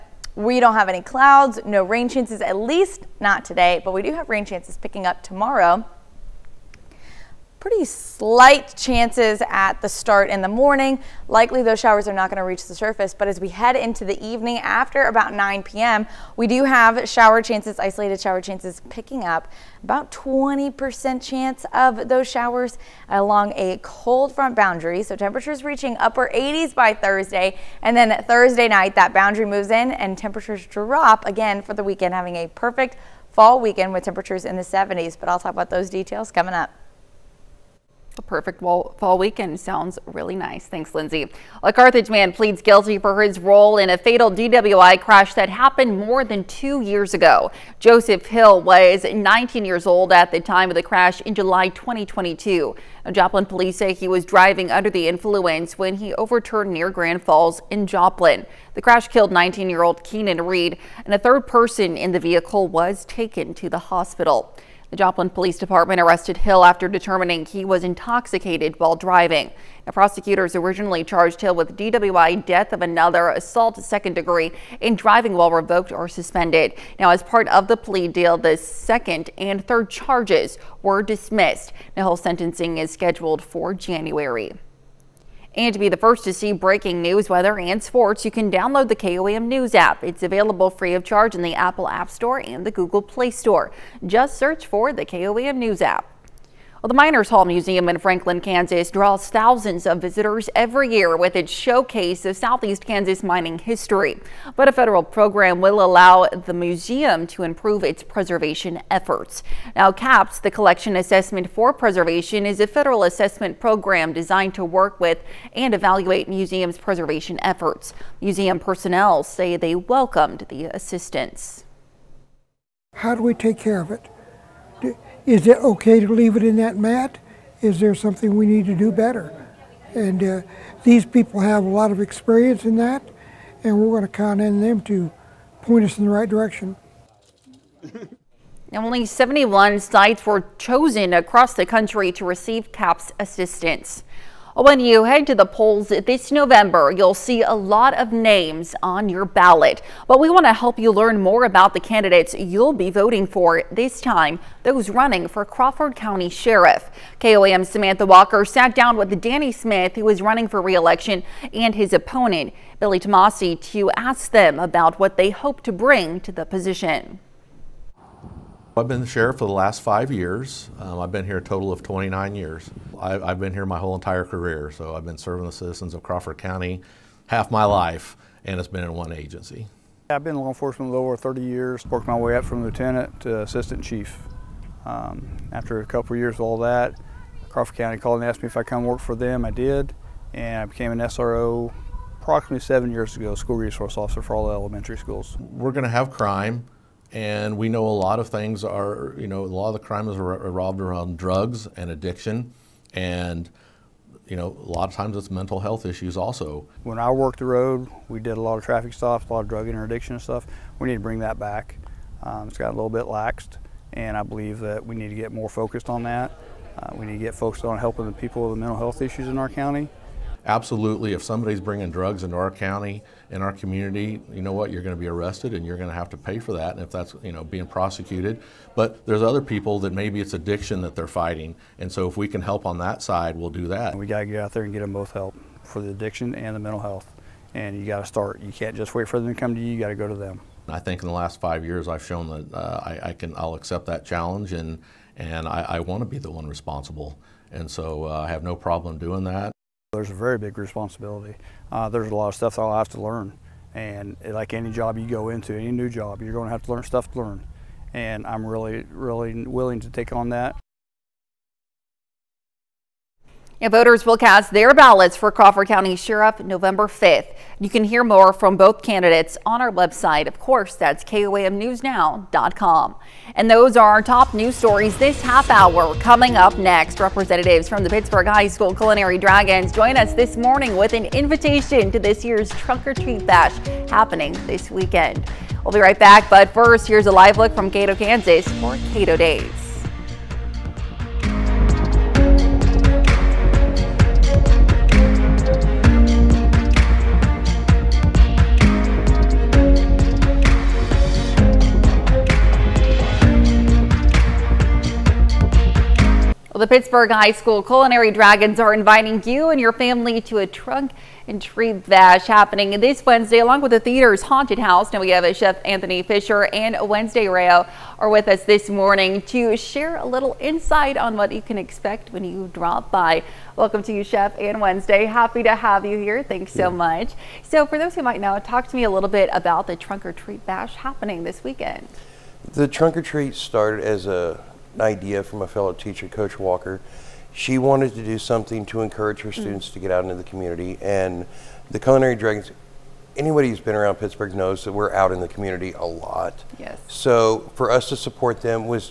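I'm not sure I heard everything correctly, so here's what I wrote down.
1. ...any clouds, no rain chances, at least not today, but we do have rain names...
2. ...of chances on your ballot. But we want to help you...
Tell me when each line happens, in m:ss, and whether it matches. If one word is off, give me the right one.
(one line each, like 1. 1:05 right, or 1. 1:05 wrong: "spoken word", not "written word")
1. 0:00 wrong: "chances", not "names"
2. 2:27 wrong: "names", not "chances".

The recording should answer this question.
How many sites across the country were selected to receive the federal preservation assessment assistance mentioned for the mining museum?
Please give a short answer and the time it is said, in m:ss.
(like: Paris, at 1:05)
71, at 2:19.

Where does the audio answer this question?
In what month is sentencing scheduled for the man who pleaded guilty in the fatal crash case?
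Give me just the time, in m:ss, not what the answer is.
1:23.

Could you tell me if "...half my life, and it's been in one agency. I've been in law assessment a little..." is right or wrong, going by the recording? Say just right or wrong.
wrong.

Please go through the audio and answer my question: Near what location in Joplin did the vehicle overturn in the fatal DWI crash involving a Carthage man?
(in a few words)
Grand Falls.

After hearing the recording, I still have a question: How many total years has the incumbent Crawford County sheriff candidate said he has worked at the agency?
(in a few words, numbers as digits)
29.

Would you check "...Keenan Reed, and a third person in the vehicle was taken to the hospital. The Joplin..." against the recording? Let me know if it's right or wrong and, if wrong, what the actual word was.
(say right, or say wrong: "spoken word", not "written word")
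right.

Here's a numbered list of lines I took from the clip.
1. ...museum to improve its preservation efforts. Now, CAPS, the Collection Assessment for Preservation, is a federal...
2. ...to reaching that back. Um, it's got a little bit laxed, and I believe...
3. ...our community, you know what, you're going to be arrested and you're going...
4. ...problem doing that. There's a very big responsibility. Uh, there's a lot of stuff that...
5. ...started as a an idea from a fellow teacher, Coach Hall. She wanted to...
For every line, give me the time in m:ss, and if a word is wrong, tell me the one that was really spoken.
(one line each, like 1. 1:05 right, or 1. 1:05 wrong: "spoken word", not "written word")
1. 1:46 right
2. 3:30 wrong: "bring", not "reaching"
3. 3:43 right
4. 4:08 right
5. 5:33 wrong: "Walker", not "Hall".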